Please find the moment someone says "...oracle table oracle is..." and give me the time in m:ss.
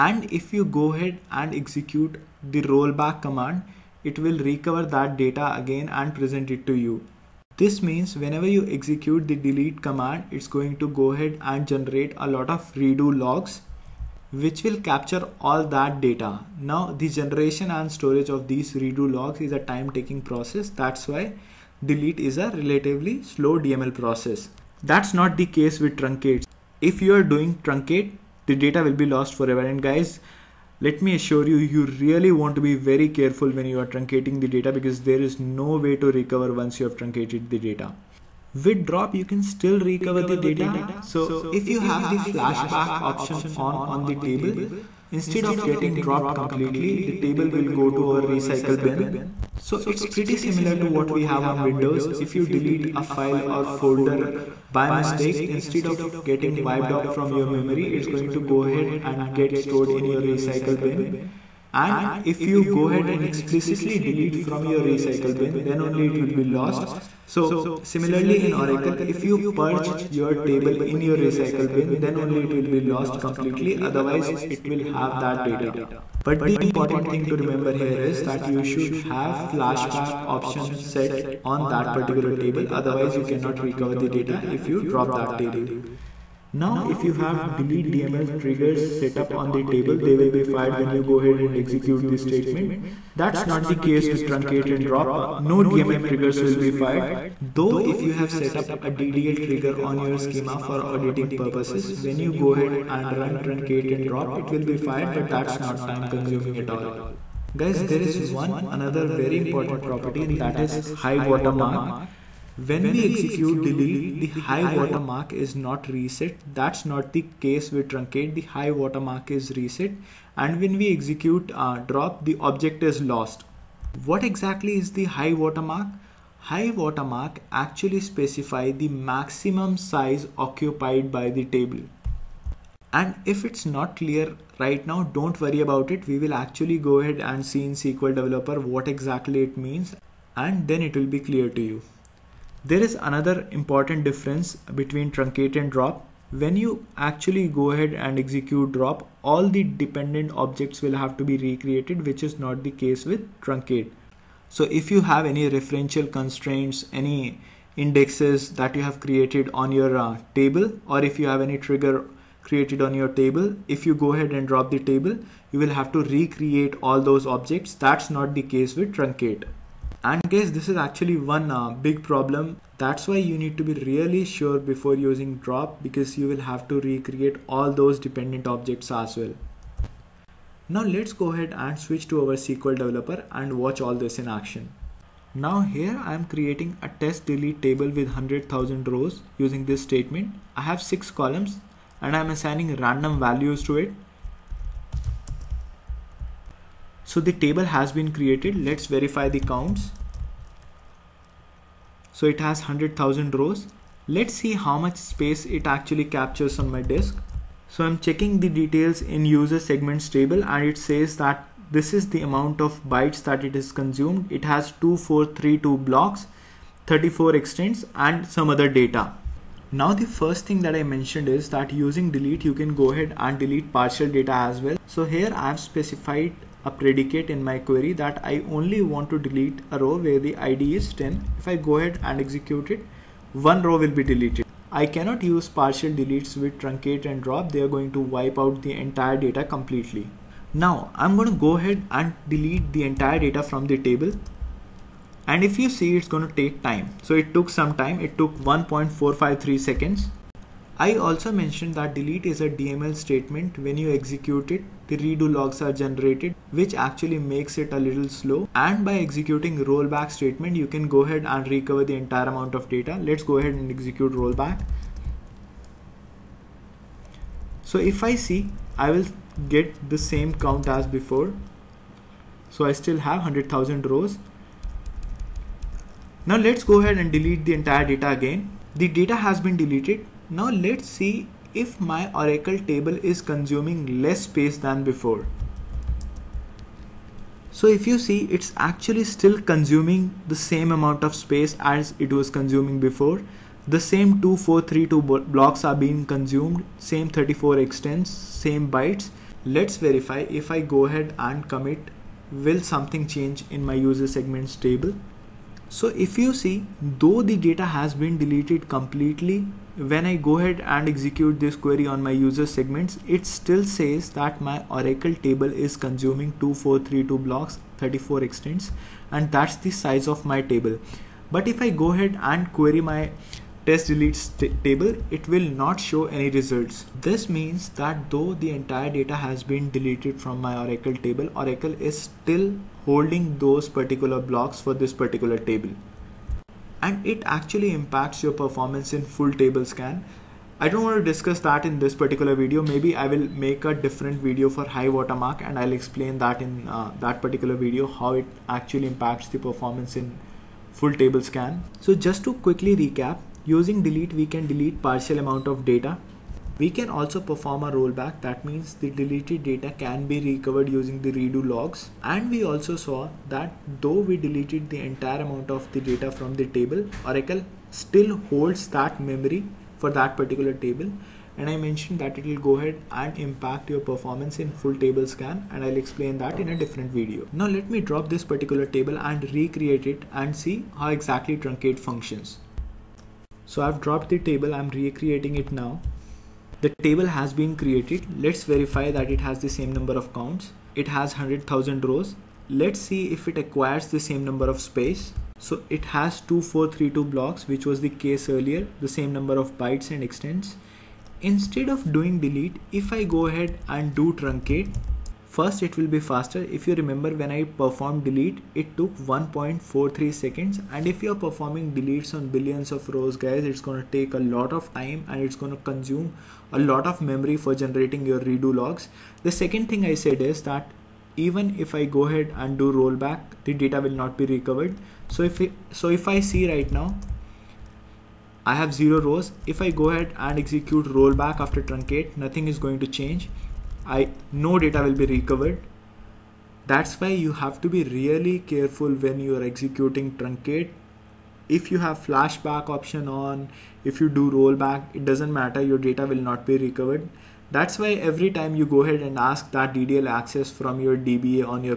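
5:30.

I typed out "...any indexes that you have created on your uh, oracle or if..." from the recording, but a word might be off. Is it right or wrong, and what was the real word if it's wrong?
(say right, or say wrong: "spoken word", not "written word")
wrong: "table", not "oracle".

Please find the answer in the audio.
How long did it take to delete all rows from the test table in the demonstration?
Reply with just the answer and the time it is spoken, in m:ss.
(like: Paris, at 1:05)
1.453 seconds, at 4:08.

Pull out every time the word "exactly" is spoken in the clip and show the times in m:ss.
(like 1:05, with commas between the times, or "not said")
2:04, 2:18, 6:20.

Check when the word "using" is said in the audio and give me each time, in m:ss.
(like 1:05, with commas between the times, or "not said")
2:54, 3:09, 3:41, 5:53, 6:00.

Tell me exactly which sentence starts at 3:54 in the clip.
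I cannot use partial deletes with truncate and drop.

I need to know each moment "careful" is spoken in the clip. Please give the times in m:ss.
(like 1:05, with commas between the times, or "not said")
0:33, 7:18.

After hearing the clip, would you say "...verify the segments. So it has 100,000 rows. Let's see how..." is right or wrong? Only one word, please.
wrong.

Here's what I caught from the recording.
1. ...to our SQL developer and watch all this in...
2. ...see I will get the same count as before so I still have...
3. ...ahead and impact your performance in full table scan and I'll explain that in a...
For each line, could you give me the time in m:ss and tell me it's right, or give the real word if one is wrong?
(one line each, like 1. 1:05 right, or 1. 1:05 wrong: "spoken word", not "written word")
1. 3:02 right
2. 4:28 right
3. 6:12 right.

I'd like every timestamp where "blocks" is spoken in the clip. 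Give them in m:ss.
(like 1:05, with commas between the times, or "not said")
3:35, 4:55, 5:17, 5:34, 6:37.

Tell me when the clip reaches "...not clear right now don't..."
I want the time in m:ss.
2:13.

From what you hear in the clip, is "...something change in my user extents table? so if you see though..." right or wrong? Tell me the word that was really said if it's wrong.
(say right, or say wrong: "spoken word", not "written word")
wrong: "segments", not "extents".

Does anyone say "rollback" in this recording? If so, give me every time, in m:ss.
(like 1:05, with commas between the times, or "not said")
0:02, 4:19, 4:24, 5:57, 7:02, 7:10, 7:24.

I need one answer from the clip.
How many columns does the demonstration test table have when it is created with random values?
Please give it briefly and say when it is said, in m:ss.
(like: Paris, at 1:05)
6, at 3:10.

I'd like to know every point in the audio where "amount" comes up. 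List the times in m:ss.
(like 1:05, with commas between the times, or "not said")
3:32, 4:22, 4:50, 5:55, 6:05.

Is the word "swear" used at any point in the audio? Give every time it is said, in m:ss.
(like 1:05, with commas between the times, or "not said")
not said.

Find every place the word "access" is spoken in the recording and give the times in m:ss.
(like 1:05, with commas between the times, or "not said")
7:30.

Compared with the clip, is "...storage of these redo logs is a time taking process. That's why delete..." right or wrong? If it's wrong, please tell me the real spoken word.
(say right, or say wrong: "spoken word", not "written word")
right.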